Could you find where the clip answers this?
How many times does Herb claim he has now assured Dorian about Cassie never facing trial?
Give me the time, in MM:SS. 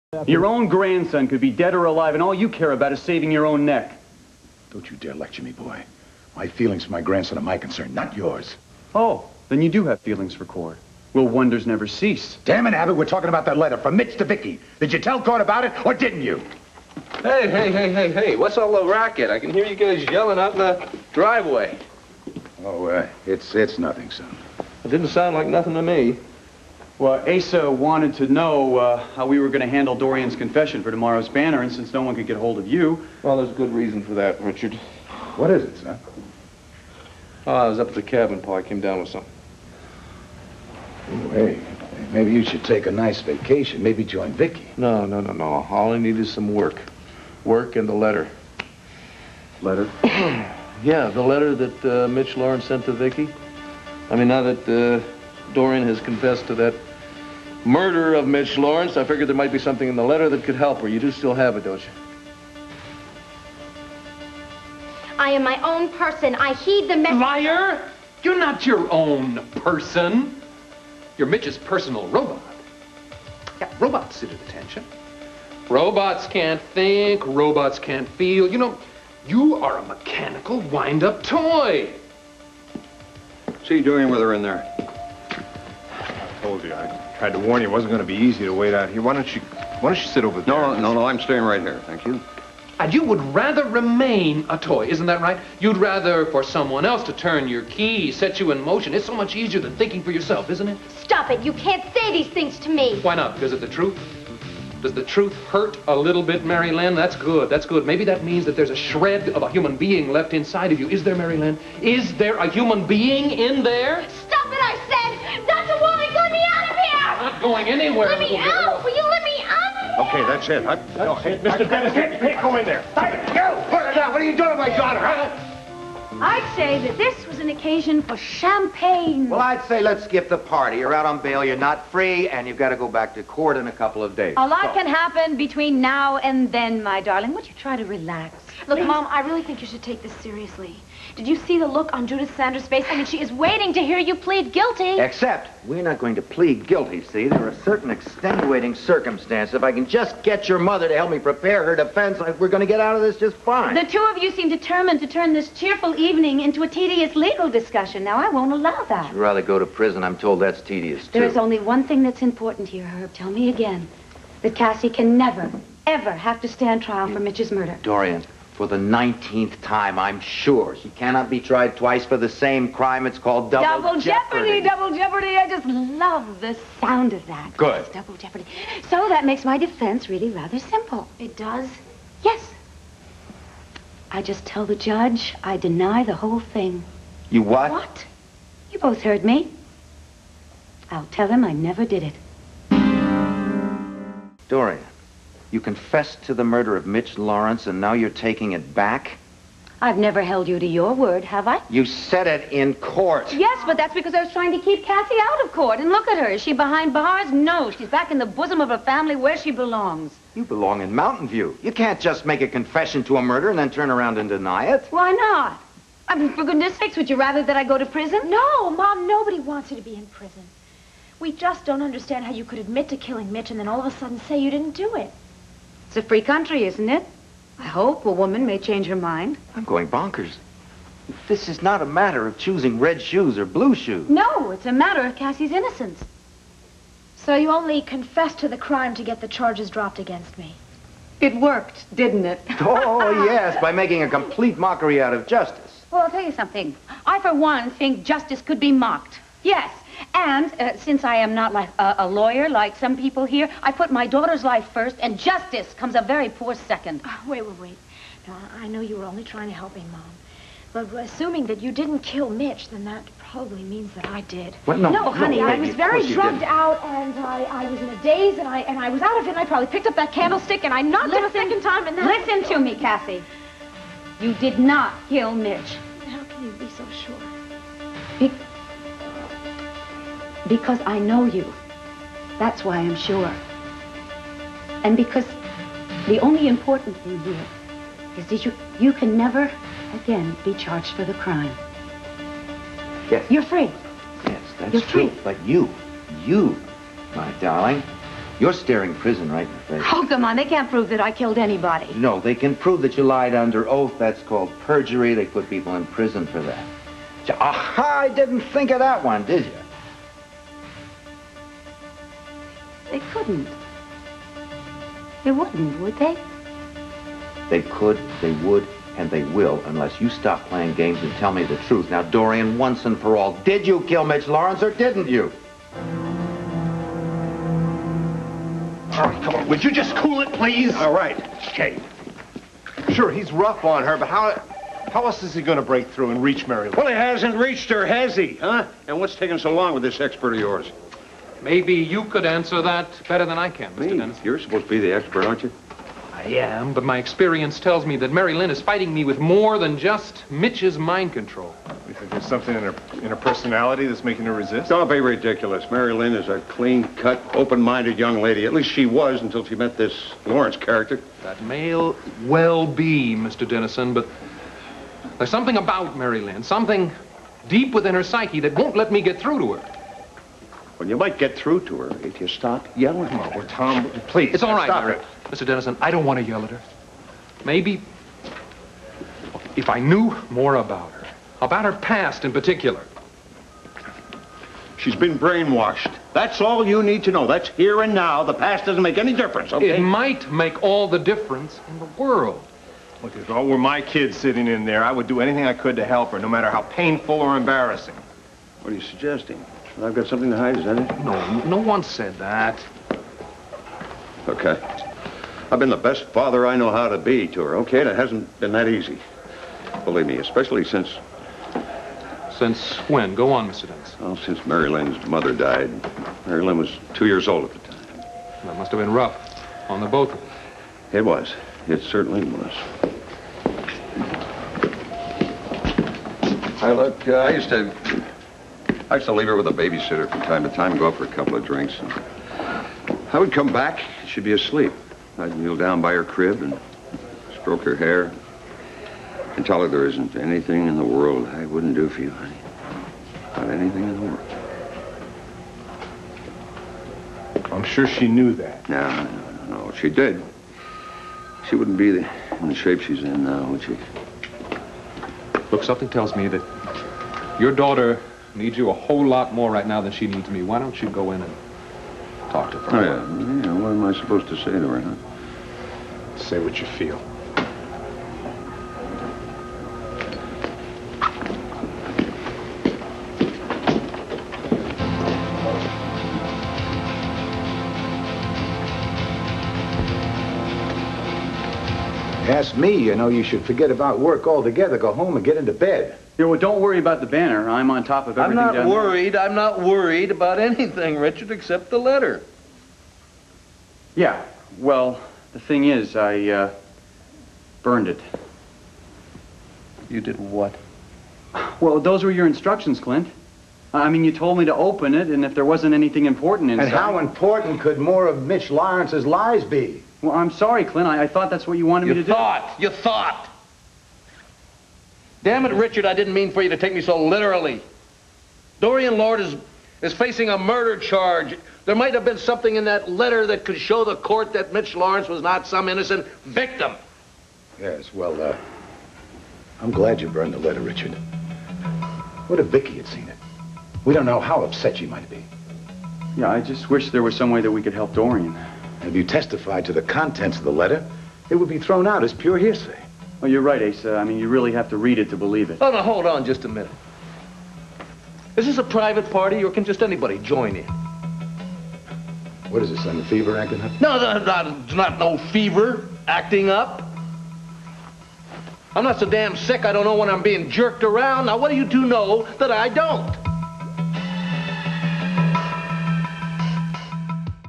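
02:48.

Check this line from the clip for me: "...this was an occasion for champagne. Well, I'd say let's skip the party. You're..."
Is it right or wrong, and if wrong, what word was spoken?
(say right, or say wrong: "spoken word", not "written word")
right.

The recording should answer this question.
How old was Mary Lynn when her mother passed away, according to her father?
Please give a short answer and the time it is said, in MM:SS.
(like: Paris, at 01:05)
2, at 06:56.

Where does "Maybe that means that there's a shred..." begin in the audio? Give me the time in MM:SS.
01:47.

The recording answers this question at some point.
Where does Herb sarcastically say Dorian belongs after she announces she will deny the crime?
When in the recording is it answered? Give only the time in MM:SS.
03:30.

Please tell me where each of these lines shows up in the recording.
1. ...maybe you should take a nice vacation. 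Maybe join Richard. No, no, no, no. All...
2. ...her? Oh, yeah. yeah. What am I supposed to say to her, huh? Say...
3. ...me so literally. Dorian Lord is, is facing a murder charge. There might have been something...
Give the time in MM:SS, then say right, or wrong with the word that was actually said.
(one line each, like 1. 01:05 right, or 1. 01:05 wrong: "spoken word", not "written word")
1. 00:42 wrong: "Vicky", not "Richard"
2. 07:42 right
3. 08:36 right.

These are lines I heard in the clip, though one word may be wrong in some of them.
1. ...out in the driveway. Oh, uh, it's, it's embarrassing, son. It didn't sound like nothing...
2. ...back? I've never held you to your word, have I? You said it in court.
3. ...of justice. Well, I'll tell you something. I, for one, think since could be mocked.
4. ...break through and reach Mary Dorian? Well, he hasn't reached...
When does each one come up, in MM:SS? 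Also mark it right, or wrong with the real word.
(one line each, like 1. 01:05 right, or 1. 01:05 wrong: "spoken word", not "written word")
1. 00:20 wrong: "nothing", not "embarrassing"
2. 03:18 right
3. 04:05 wrong: "justice", not "since"
4. 05:35 wrong: "Lou", not "Dorian".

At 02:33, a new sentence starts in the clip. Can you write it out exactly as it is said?
The two of you seem determined to turn this cheerful evening into a tedious legal discussion.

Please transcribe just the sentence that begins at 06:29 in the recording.
It might make all the difference in the world.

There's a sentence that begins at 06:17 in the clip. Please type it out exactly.
Maybe if I knew more about her, about her past in particular.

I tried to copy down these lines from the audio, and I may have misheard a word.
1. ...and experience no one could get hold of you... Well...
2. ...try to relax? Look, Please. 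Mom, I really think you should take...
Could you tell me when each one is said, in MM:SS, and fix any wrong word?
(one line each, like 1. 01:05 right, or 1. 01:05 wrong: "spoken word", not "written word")
1. 00:31 wrong: "since", not "experience"
2. 02:17 right.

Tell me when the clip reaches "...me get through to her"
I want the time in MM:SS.
06:08.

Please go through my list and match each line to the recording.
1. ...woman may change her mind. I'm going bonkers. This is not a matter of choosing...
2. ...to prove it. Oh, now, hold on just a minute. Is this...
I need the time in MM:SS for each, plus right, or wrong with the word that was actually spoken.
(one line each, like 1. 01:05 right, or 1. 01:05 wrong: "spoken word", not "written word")
1. 03:48 right
2. 09:05 wrong: "believe", not "prove".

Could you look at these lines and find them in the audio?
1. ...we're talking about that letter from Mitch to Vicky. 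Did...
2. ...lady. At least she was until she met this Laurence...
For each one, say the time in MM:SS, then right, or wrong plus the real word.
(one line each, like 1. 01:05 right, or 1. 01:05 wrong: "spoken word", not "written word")
1. 00:12 right
2. 05:58 right.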